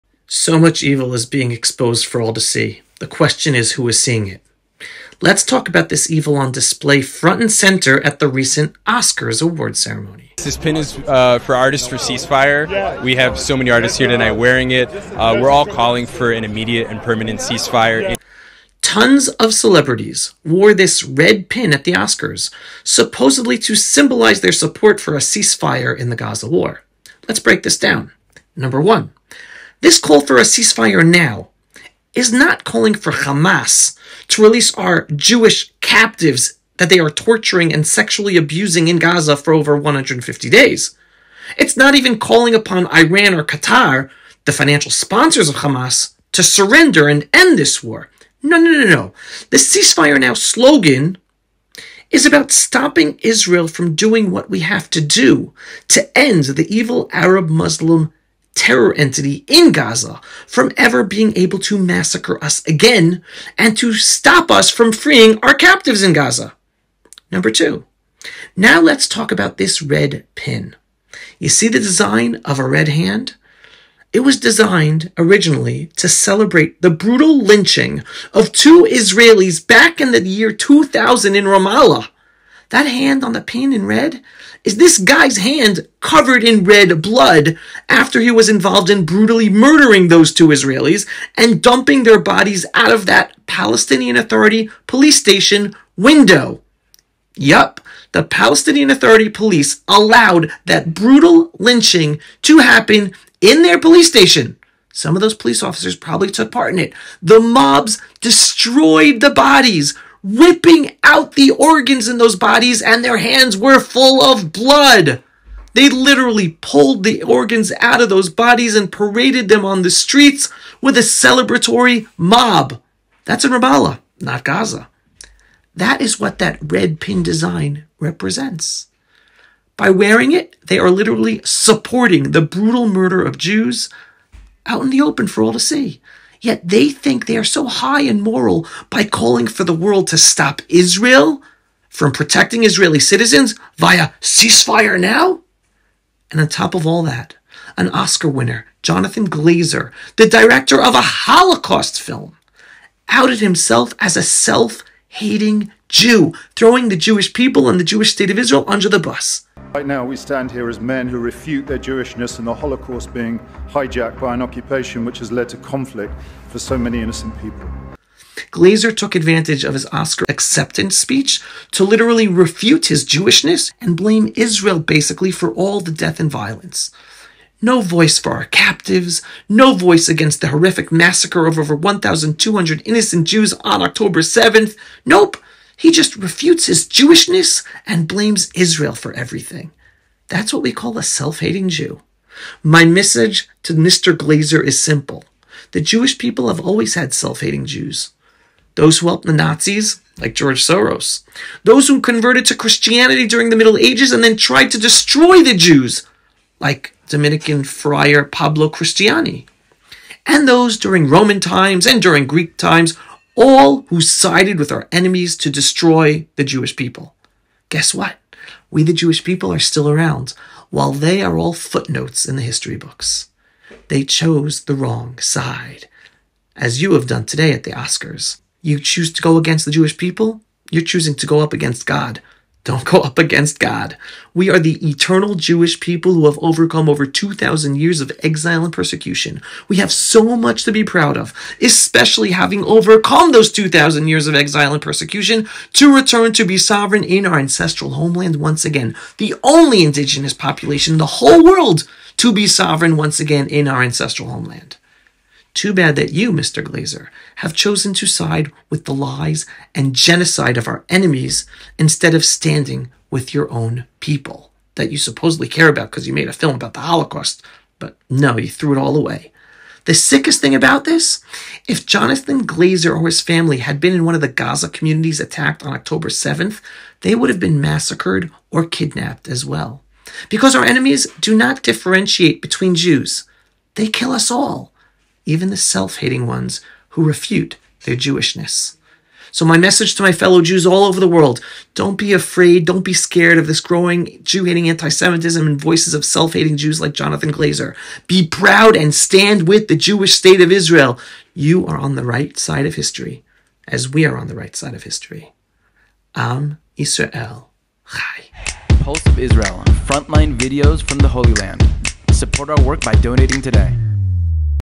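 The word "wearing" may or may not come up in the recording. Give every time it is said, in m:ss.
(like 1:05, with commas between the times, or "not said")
0:14, 2:09.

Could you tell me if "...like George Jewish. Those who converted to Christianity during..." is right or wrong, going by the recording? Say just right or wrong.
wrong.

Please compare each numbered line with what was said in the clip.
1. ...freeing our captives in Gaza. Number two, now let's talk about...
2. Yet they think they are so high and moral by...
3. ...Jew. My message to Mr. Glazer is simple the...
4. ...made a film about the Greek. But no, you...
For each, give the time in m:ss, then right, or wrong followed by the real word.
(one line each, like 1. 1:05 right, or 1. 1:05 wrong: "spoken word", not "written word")
1. 1:04 right
2. 2:16 right
3. 3:11 right
4. 4:26 wrong: "Holocaust", not "Greek".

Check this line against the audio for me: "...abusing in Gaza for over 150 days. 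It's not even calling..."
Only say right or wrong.
right.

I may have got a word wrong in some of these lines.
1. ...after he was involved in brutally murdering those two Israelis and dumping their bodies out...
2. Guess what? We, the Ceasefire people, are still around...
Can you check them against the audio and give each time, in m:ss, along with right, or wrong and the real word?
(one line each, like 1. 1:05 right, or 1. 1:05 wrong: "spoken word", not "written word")
1. 1:27 right
2. 3:37 wrong: "Jewish", not "Ceasefire".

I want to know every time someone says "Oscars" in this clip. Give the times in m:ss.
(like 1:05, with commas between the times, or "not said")
0:08, 0:21, 2:27, 2:49, 3:47.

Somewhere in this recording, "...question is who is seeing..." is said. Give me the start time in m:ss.
0:03.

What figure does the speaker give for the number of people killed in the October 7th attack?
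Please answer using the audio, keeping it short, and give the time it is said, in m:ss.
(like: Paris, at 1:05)
over 1,200, at 3:01.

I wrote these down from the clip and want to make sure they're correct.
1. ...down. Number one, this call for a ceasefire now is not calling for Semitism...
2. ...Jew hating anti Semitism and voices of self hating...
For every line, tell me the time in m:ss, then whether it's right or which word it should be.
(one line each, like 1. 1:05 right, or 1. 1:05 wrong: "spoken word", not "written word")
1. 0:27 wrong: "Hamas", not "Semitism"
2. 4:54 right.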